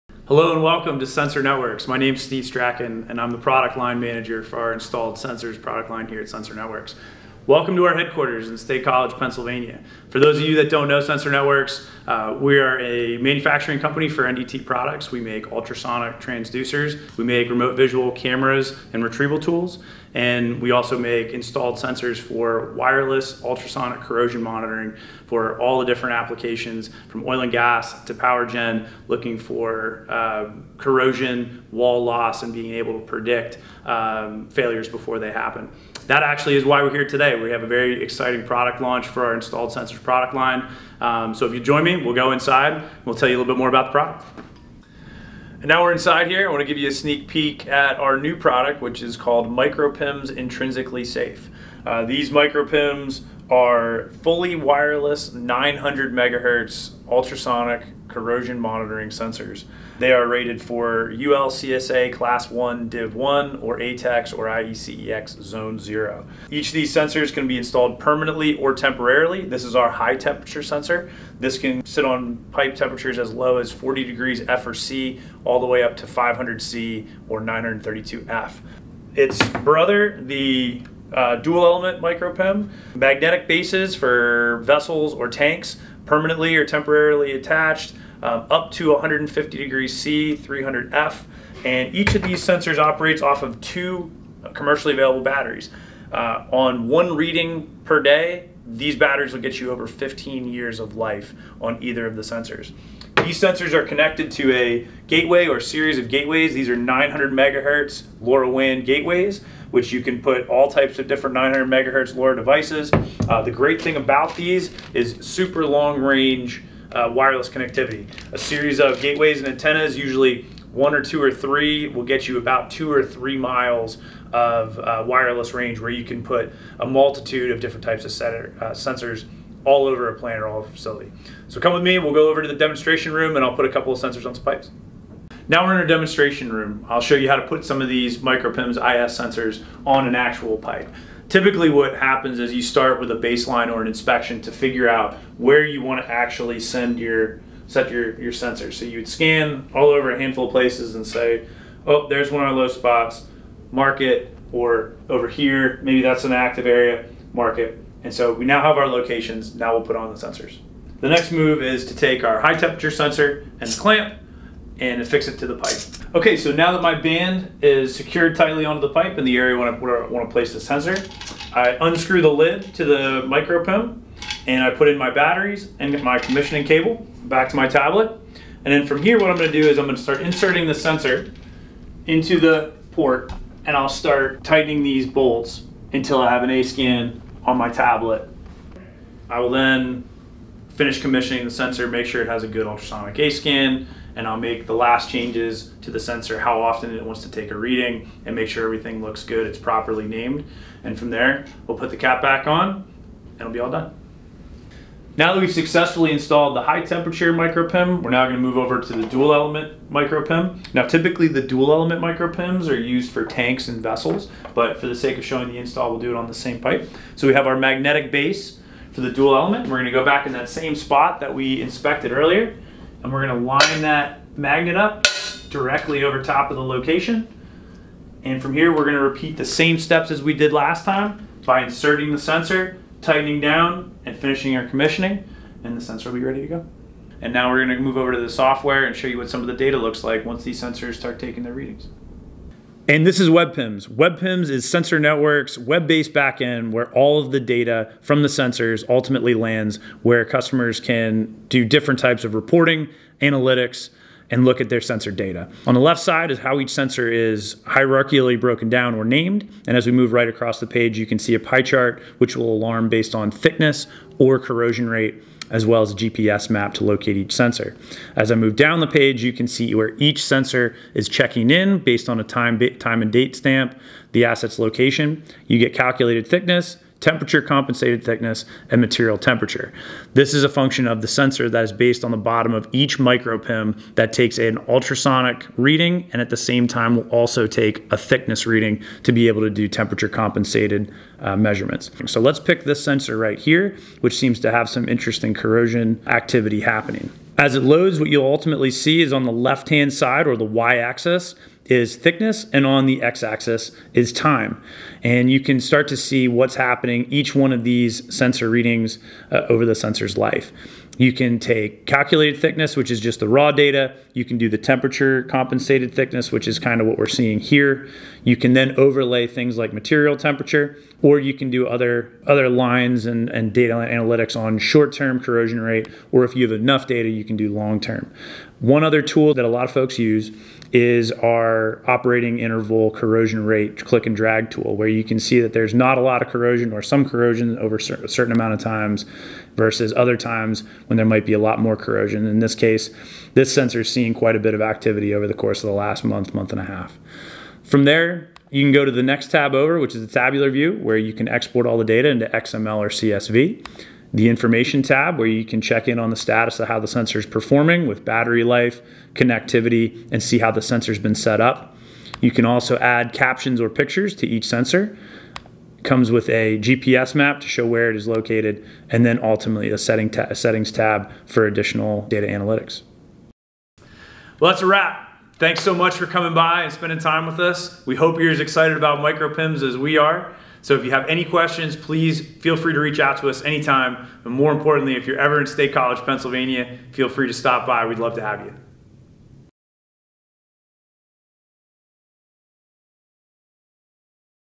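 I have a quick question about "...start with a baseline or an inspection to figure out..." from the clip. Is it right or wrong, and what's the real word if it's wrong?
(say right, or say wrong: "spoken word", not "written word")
right.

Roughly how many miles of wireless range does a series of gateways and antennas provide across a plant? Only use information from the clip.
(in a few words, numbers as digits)
2 or 3 miles.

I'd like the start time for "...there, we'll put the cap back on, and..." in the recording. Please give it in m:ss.
3:21.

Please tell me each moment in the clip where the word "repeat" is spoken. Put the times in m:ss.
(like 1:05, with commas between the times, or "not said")
3:49.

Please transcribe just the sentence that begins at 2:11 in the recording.
So come with me, we'll go over to the demonstration room and I'll put a couple of sensors on some pipes.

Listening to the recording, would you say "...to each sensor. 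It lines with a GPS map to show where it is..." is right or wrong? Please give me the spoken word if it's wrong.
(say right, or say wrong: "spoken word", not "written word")
wrong: "comes", not "lines".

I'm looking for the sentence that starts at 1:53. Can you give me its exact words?
Uh, the great thing about these is super long range uh, wireless connectivity.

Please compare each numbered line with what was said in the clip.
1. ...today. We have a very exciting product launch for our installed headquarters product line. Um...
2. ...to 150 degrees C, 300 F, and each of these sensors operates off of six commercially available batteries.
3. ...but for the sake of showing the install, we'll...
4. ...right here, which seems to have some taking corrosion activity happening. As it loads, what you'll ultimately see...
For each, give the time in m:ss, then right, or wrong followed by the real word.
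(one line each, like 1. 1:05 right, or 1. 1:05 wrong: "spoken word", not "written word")
1. 0:37 wrong: "sensors", not "headquarters"
2. 1:28 wrong: "two", not "six"
3. 3:34 right
4. 4:53 wrong: "interesting", not "taking".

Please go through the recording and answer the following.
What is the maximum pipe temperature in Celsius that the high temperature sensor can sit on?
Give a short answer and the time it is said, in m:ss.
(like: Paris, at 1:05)
500 C, at 1:16.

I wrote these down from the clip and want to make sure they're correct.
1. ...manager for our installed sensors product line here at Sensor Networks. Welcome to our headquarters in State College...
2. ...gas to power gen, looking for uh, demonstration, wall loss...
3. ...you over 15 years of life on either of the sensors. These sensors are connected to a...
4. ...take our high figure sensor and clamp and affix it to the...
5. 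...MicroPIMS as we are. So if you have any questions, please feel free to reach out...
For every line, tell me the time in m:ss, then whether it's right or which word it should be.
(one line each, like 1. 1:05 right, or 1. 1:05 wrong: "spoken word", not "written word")
1. 0:03 right
2. 0:27 wrong: "corrosion", not "demonstration"
3. 1:39 right
4. 2:41 wrong: "temperature", not "figure"
5. 6:18 right.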